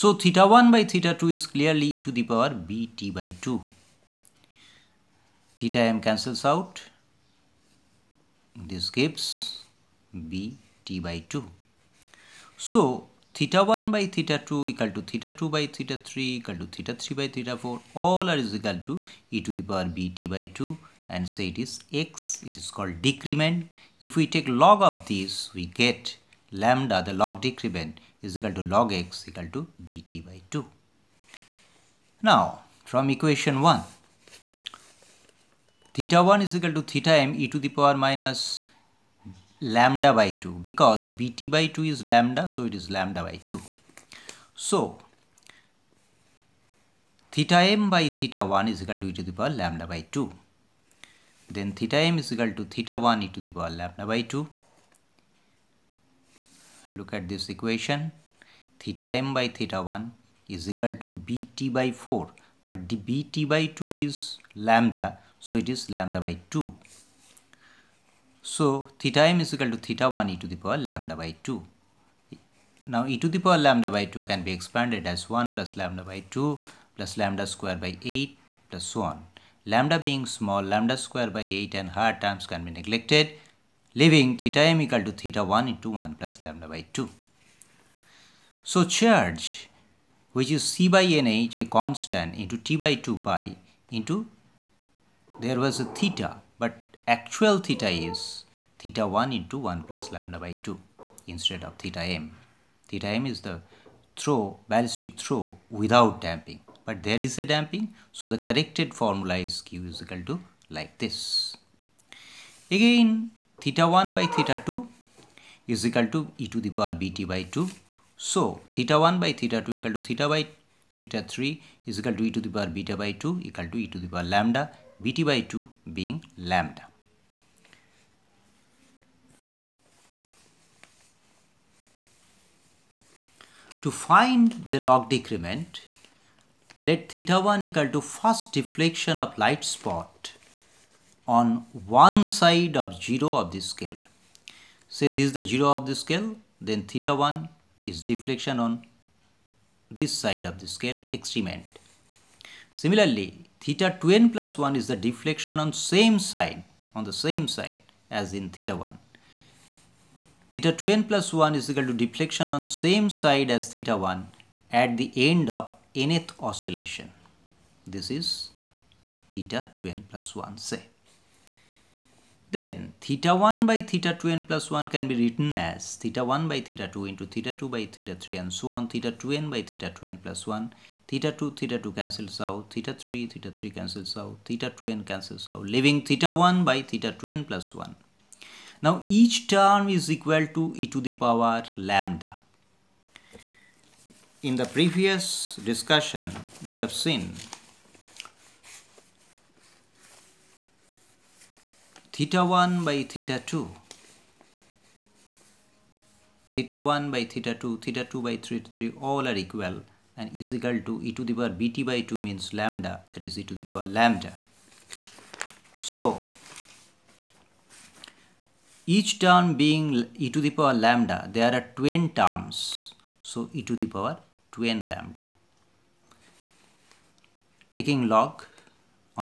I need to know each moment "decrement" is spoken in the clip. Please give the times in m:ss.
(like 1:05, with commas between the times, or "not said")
0:23, 0:27, 2:15.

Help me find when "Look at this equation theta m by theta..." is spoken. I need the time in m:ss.
0:56.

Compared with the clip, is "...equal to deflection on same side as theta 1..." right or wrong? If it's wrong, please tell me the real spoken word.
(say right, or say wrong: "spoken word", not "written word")
right.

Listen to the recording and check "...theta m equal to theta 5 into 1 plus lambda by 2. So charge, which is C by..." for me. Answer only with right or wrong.
wrong.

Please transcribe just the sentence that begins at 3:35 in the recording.
So, each term being e to the power lambda, there are 10 terms.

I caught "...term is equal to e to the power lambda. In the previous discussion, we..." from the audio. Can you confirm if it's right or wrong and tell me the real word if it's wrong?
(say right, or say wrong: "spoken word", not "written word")
right.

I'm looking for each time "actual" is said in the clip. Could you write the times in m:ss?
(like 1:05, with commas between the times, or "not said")
1:37.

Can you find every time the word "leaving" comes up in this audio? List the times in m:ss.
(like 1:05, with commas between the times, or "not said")
1:23, 3:05.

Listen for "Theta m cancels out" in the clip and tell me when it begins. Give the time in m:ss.
0:05.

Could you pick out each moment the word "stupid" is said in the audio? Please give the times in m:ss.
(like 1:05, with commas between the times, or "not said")
not said.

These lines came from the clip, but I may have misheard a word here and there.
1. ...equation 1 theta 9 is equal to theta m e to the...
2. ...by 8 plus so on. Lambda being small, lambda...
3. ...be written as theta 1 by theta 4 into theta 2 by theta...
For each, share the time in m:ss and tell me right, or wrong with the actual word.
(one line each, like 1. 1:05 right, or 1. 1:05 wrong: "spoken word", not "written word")
1. 0:33 wrong: "1", not "9"
2. 1:17 right
3. 2:55 wrong: "2", not "4".